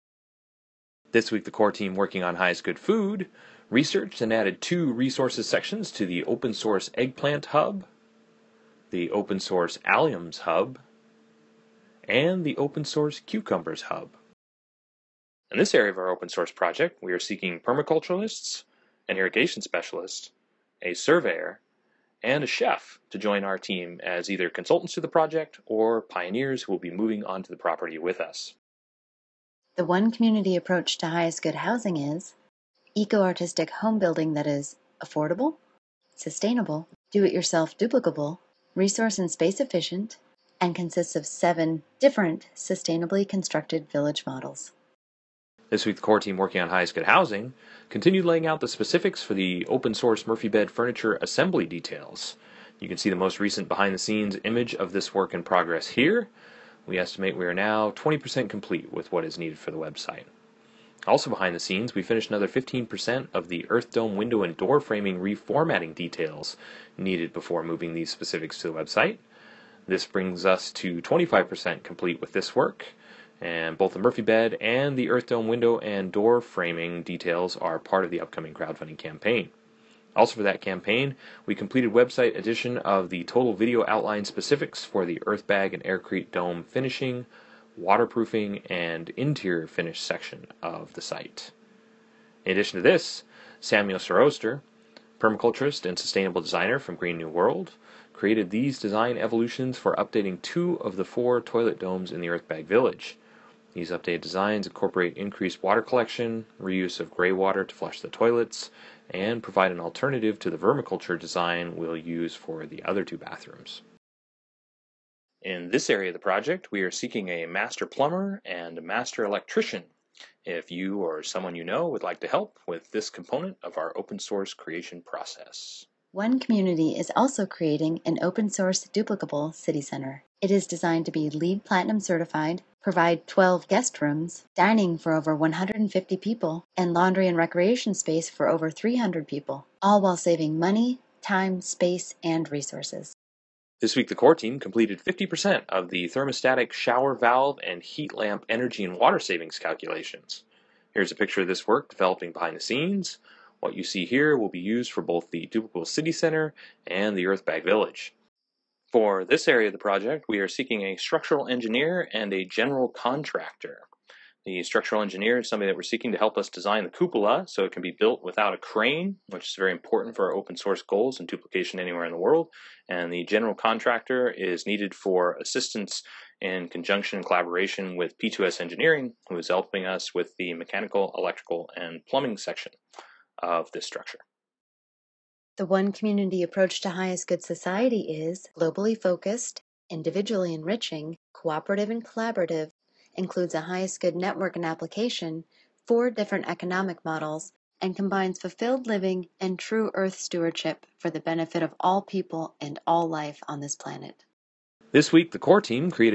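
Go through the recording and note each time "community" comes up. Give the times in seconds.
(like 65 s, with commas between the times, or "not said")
30 s, 126 s, 185 s.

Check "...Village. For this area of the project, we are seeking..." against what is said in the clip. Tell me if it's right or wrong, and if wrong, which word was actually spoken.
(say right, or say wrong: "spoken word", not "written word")
right.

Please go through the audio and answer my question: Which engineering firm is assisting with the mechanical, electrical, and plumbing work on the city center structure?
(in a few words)
P2S Engineering.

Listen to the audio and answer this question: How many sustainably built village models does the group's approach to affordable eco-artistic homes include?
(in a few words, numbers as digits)
7.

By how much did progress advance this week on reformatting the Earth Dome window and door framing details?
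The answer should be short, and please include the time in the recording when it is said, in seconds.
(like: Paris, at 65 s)
15%, at 62 s.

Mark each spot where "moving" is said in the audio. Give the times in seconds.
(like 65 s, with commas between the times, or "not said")
26 s, 67 s.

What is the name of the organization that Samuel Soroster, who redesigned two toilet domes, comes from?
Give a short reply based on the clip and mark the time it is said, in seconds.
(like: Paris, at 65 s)
Green New World, at 96 s.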